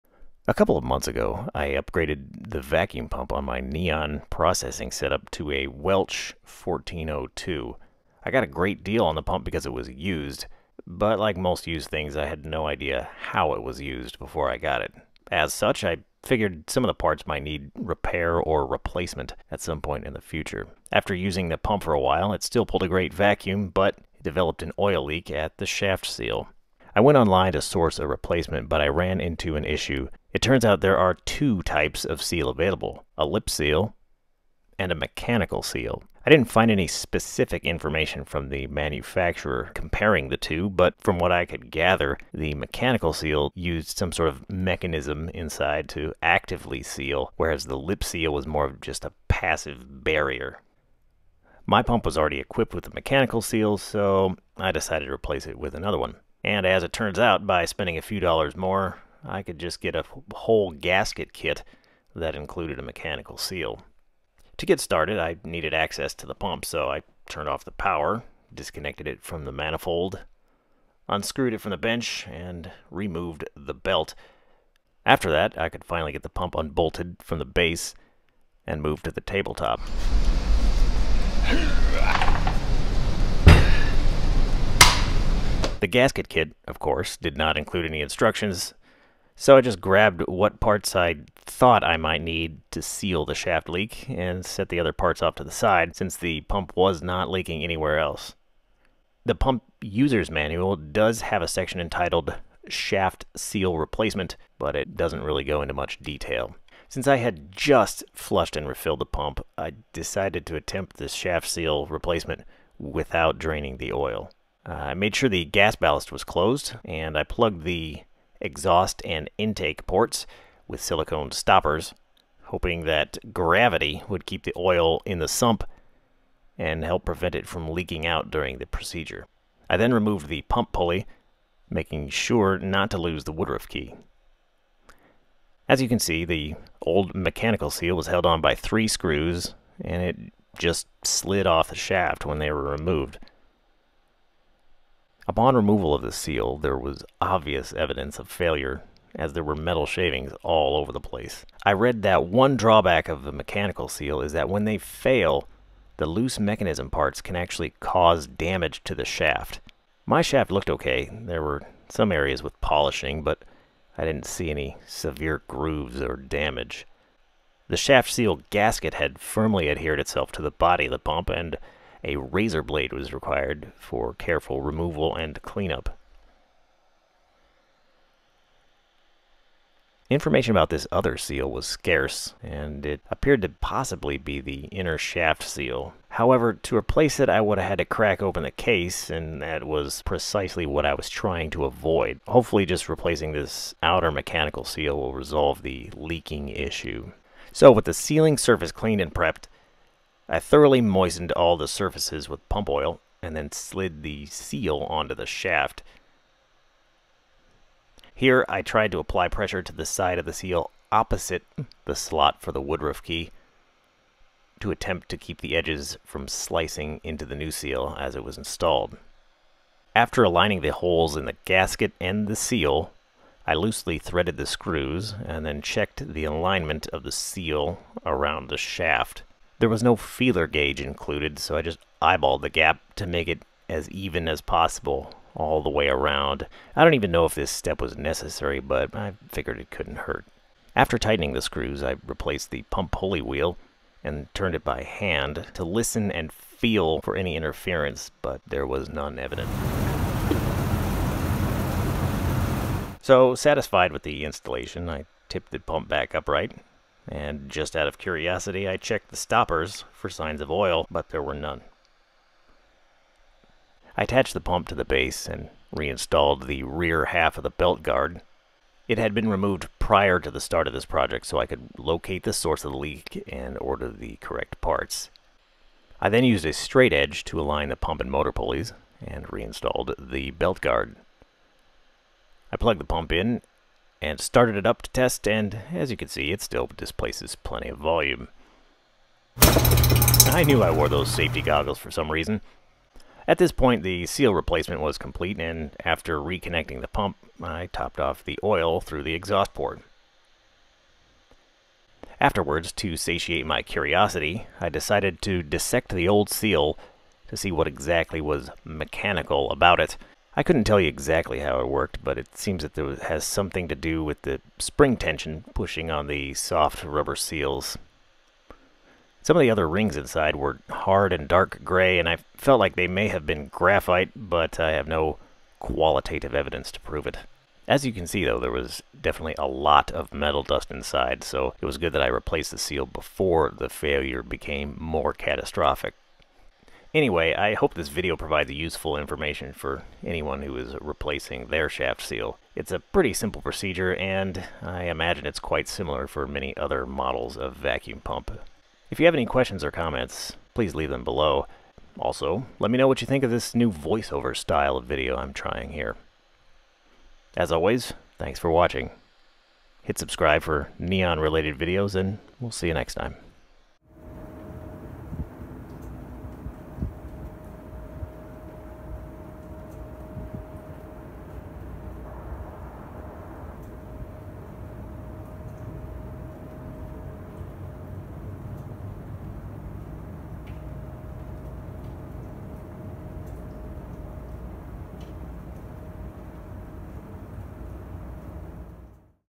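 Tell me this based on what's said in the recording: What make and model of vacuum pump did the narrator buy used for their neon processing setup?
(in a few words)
Welch 1402.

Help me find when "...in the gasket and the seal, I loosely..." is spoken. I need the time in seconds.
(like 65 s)
221 s.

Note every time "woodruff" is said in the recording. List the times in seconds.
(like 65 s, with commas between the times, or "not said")
133 s, 212 s.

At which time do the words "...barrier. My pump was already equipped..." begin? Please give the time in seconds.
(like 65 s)
50 s.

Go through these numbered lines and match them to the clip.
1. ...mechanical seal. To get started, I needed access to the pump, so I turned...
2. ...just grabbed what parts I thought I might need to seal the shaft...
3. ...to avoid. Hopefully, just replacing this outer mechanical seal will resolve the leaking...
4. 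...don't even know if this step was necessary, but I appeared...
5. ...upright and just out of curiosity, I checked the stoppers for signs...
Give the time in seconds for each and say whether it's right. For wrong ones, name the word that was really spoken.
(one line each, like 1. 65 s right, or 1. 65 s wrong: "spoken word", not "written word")
1. 62 s right
2. 89 s right
3. 191 s right
4. 236 s wrong: "figured", not "appeared"
5. 256 s right.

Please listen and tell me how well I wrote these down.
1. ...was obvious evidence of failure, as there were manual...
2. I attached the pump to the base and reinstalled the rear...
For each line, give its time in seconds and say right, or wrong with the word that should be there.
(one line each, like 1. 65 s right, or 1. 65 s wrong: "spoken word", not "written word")
1. 146 s wrong: "metal", not "manual"
2. 263 s right.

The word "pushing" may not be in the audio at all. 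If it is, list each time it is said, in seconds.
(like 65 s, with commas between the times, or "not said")
315 s.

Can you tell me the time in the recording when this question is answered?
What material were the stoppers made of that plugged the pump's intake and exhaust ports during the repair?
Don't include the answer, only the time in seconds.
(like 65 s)
120 s.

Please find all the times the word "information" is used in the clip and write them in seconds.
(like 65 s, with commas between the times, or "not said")
37 s, 180 s, 338 s.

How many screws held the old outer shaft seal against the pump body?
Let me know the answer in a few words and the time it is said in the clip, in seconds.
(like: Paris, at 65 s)
3, at 138 s.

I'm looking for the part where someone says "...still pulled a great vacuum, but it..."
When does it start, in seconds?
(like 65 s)
22 s.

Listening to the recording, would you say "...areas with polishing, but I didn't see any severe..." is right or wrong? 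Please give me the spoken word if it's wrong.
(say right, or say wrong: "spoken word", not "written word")
right.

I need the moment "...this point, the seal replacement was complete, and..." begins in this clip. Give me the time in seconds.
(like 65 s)
293 s.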